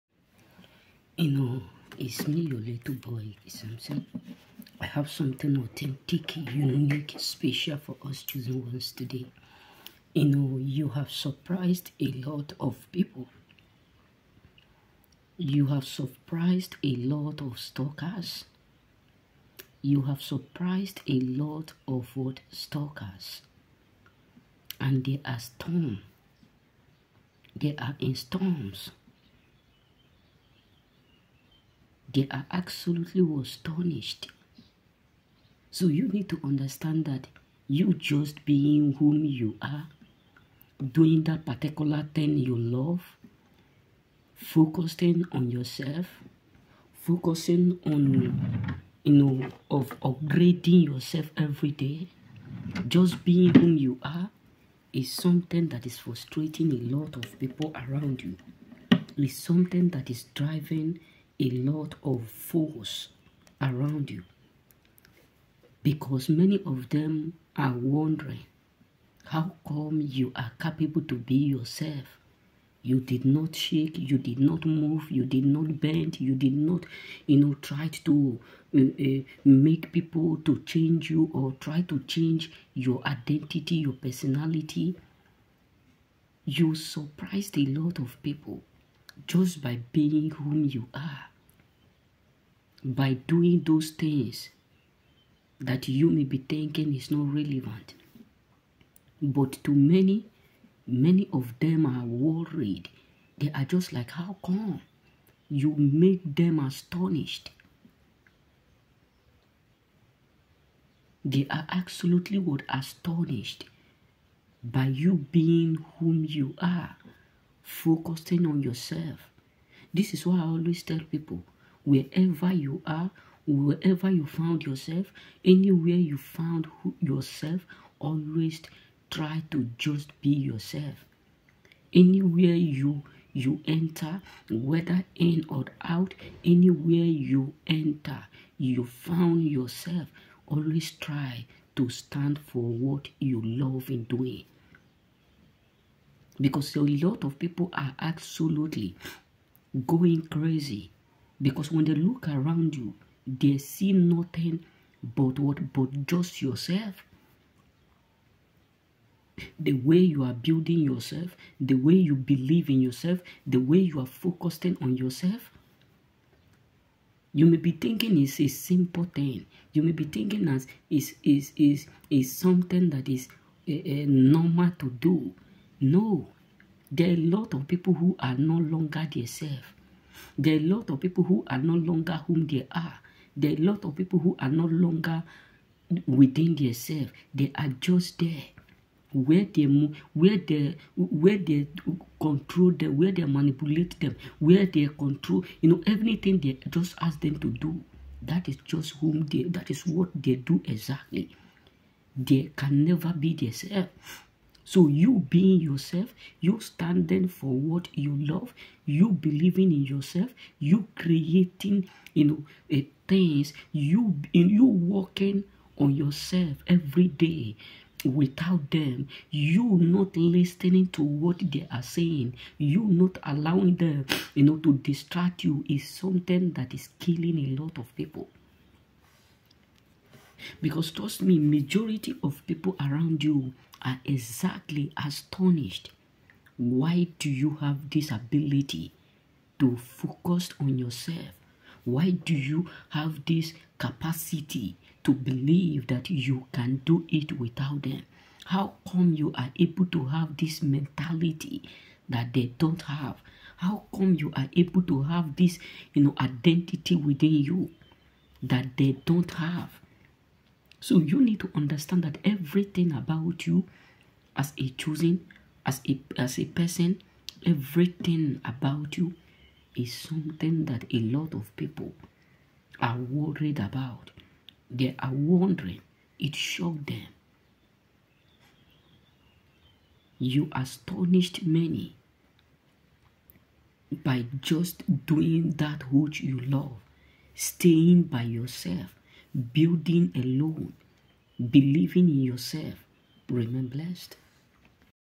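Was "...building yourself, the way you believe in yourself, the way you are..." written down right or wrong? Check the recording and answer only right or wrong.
right.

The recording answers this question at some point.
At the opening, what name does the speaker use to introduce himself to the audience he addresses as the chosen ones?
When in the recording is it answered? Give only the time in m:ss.
0:03.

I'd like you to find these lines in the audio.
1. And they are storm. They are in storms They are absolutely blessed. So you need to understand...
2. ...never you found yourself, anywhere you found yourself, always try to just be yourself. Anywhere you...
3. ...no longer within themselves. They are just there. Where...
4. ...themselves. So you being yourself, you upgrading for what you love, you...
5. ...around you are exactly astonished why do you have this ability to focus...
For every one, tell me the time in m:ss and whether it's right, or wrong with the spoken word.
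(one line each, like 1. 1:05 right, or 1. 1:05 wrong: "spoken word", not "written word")
1. 0:24 wrong: "astonished", not "blessed"
2. 2:03 wrong: "wherever", not "never"
3. 3:04 right
4. 3:23 wrong: "standing", not "upgrading"
5. 3:52 right.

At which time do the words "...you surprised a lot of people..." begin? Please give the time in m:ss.
1:26.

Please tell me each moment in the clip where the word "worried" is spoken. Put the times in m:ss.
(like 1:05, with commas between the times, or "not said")
1:42, 4:32.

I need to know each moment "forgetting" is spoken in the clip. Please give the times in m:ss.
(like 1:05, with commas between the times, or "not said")
not said.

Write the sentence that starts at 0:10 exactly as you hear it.
You know, you have surprised a lot of people.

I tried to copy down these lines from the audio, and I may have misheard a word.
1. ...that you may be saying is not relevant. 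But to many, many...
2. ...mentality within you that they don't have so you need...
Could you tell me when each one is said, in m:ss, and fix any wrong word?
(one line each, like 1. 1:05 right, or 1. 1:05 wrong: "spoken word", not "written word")
1. 1:35 wrong: "thinking", not "saying"
2. 4:16 wrong: "identity", not "mentality".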